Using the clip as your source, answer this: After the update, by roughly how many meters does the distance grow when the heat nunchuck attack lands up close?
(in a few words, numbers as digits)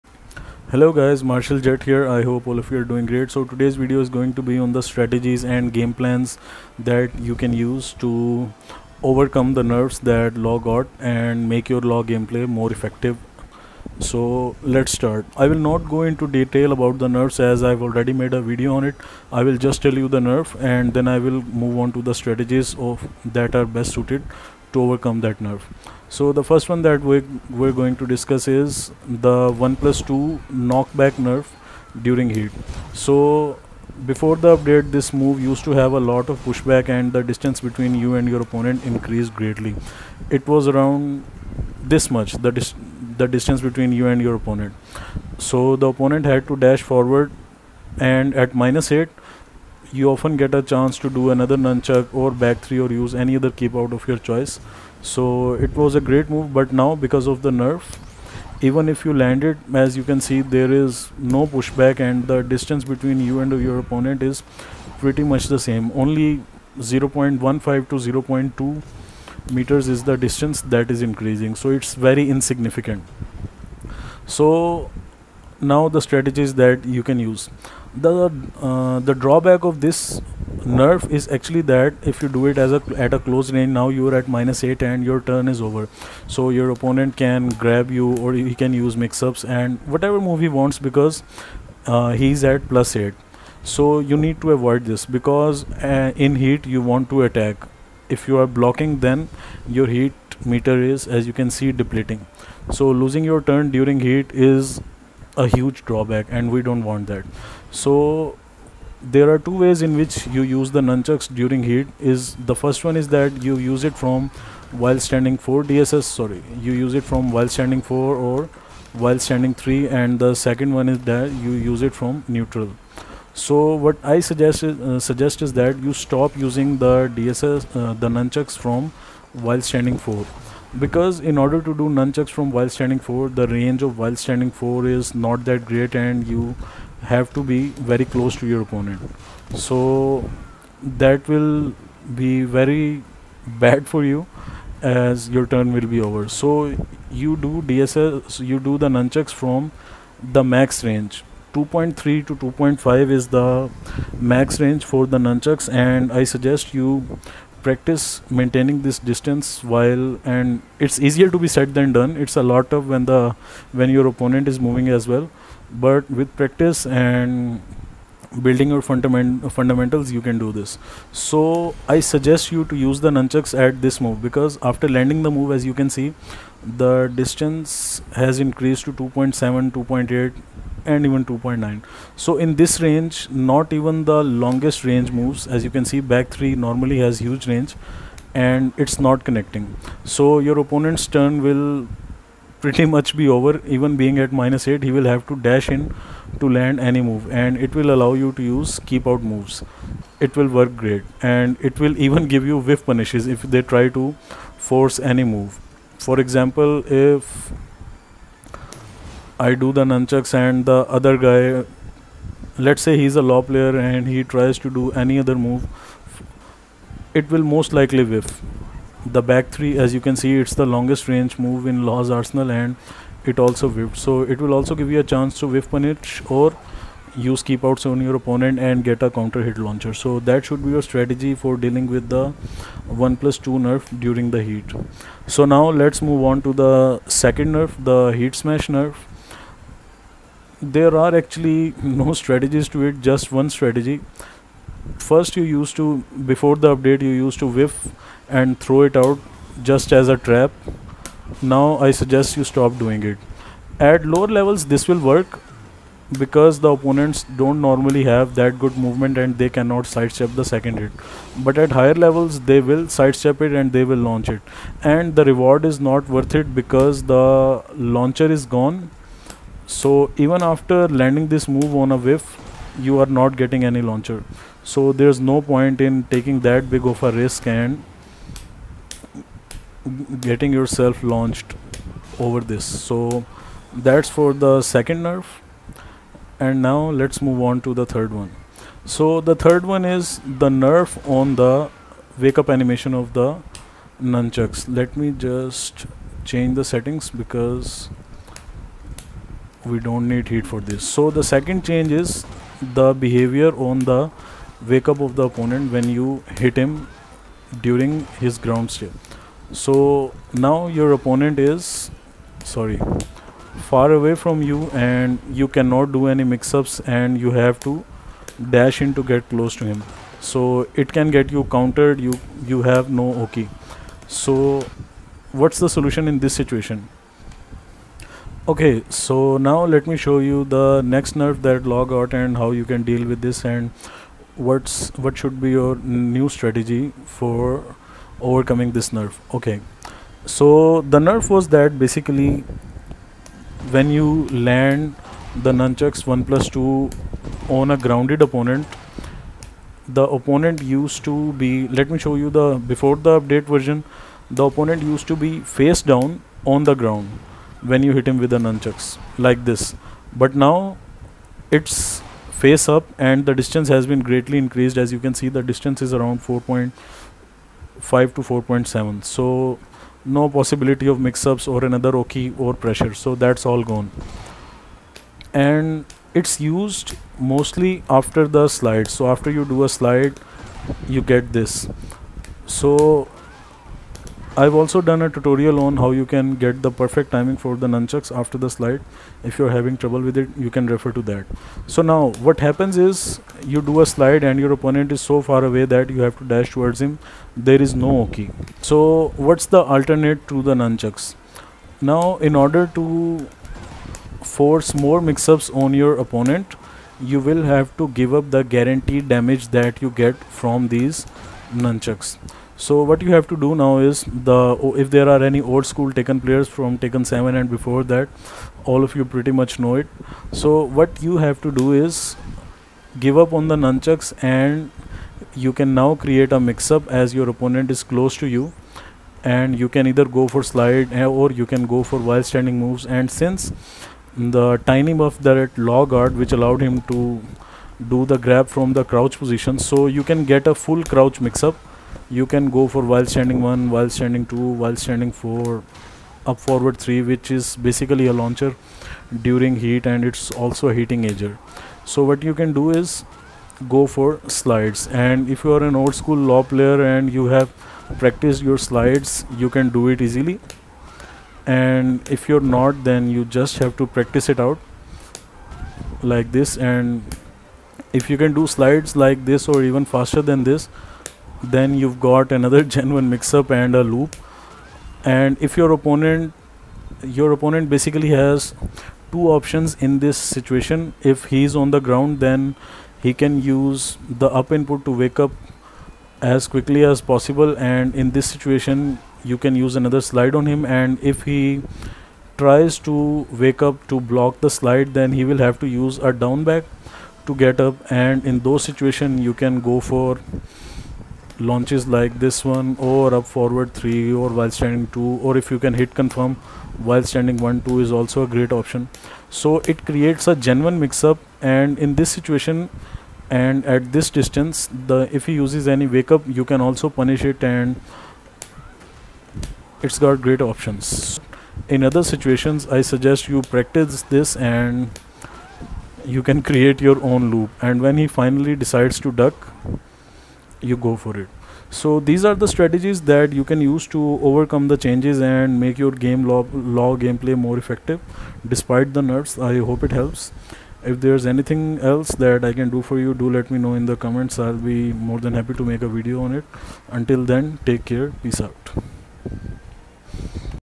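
0.15 to 0.2.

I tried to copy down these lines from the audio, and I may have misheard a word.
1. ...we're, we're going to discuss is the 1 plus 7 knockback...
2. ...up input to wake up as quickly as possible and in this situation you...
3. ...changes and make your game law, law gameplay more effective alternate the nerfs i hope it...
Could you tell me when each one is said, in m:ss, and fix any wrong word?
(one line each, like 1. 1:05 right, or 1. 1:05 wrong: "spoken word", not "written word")
1. 0:27 wrong: "2", not "7"
2. 8:04 right
3. 8:54 wrong: "despite", not "alternate".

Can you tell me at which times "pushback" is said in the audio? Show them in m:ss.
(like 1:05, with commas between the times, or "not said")
0:36, 1:01.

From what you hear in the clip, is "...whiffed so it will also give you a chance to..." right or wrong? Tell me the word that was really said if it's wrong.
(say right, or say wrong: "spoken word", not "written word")
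right.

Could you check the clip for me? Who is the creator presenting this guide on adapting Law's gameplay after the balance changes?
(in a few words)
Marshall Jutt.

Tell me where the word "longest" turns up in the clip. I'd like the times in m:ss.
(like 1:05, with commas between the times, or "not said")
3:04, 3:40.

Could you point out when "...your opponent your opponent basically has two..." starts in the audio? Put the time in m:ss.
7:55.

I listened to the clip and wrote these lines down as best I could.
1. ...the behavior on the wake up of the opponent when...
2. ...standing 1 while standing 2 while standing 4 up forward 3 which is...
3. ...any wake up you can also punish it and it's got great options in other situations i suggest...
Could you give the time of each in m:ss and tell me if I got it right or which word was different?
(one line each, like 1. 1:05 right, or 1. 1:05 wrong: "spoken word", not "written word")
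1. 5:02 right
2. 7:23 right
3. 8:35 right.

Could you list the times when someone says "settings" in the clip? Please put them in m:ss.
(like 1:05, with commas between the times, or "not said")
4:56.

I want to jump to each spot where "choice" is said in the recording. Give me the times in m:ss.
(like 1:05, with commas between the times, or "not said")
0:54.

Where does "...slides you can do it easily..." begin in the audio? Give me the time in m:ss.
7:38.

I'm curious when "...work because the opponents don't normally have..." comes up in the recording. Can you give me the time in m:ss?
4:15.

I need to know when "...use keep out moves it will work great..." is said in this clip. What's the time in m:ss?
3:18.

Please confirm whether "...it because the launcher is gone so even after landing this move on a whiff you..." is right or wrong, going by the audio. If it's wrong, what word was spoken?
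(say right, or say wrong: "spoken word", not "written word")
right.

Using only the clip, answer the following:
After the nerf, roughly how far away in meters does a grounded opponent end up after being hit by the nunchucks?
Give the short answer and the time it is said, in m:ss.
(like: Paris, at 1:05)
4.5 to 4.7, at 6:06.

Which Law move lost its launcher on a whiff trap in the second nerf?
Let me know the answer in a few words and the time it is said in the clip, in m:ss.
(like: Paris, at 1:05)
heat smash, at 3:58.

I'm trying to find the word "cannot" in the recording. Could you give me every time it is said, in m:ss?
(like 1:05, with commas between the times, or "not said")
4:19, 5:15.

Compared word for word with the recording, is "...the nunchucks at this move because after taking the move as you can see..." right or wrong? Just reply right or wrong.
wrong.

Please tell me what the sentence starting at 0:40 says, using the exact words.
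It was around this much the, dis the distance between you and your opponent.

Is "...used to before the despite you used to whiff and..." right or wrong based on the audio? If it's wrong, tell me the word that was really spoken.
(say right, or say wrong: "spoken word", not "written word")
wrong: "update", not "despite".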